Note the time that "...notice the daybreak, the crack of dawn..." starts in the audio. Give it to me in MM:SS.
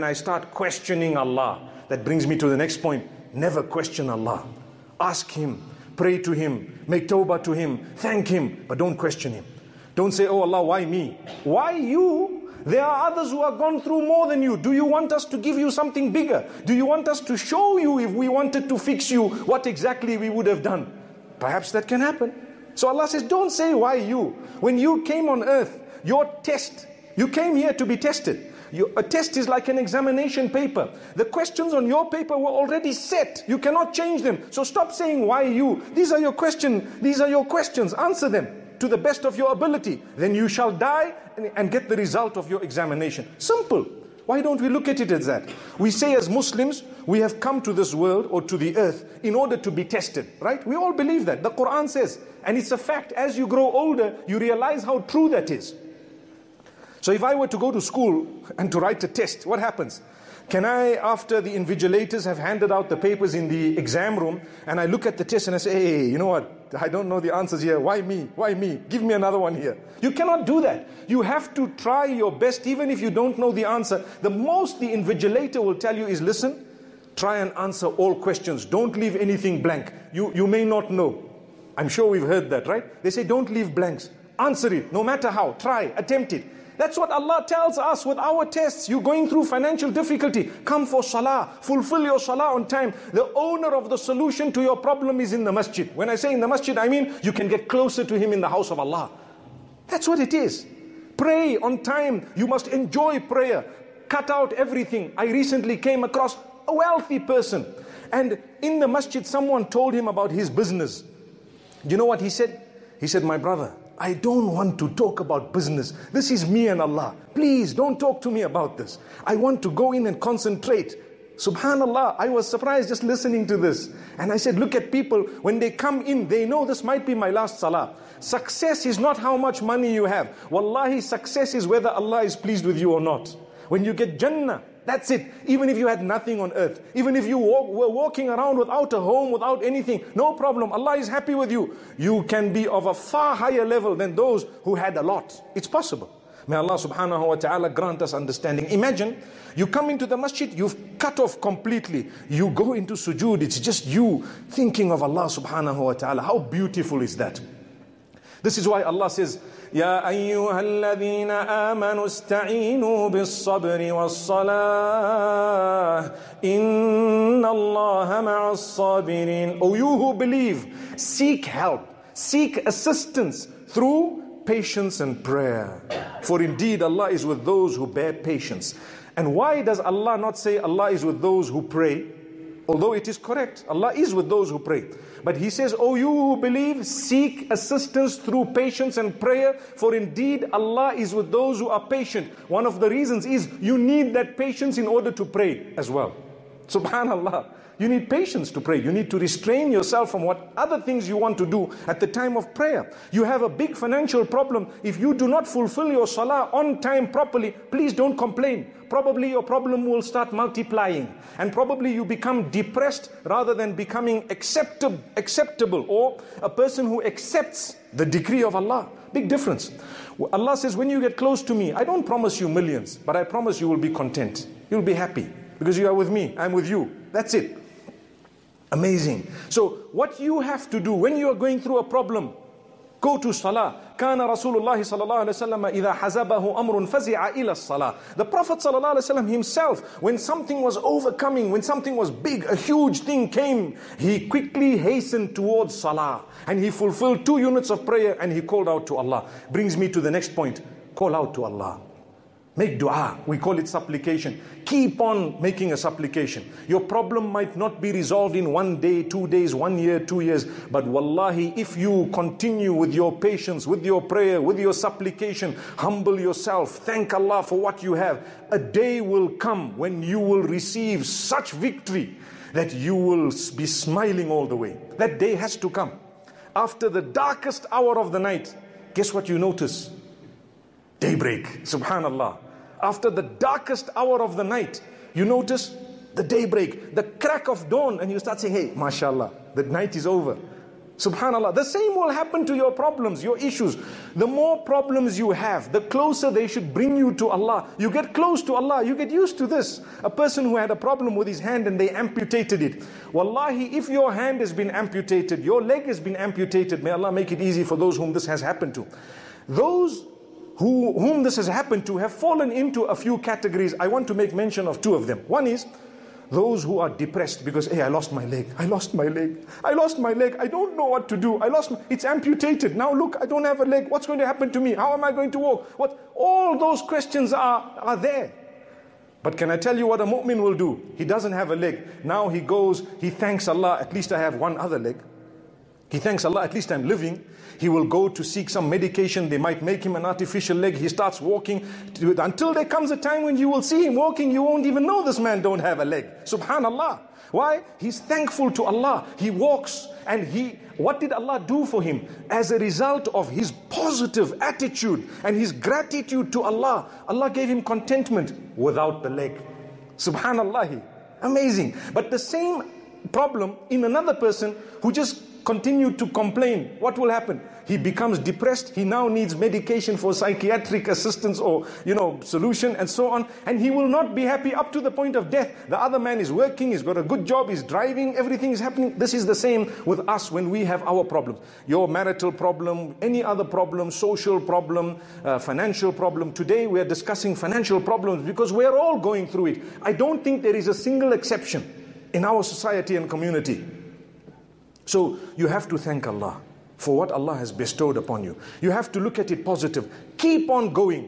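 04:45.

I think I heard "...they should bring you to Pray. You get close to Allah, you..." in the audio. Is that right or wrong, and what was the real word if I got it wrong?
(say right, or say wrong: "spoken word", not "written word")
wrong: "Allah", not "Pray".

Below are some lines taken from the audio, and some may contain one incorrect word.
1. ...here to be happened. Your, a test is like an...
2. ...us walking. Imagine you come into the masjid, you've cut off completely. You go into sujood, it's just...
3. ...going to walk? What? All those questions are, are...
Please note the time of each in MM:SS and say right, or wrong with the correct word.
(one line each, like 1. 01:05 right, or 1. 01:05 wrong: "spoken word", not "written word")
1. 00:27 wrong: "tested", not "happened"
2. 02:28 wrong: "understanding", not "walking"
3. 05:25 right.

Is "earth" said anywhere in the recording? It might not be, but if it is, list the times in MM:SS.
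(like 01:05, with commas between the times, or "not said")
00:25, 00:48, 02:16.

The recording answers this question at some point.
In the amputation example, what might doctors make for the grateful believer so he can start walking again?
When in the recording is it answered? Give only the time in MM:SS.
05:40.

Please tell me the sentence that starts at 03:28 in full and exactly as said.
Probably your problem will start multiplying.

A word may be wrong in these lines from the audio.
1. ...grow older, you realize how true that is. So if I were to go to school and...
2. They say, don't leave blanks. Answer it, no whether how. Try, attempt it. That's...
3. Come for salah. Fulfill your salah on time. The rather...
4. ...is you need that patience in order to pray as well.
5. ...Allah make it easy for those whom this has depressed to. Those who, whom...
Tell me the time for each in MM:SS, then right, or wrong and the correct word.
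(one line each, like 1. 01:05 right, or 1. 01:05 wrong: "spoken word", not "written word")
1. 00:53 right
2. 01:23 wrong: "matter", not "whether"
3. 01:30 wrong: "owner", not "rather"
4. 03:13 right
5. 05:06 wrong: "happened", not "depressed".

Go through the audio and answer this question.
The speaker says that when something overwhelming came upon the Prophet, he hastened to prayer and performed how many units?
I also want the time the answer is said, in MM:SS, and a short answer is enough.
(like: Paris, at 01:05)
2, at 04:07.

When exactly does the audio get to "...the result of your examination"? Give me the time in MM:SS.
00:41.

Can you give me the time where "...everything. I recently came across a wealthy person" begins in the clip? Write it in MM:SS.
01:44.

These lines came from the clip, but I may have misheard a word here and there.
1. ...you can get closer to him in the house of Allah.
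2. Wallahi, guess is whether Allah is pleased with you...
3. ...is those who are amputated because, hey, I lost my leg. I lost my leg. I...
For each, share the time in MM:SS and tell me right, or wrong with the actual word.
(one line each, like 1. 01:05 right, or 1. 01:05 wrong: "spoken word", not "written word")
1. 01:37 right
2. 02:10 wrong: "success", not "guess"
3. 05:15 wrong: "depressed", not "amputated".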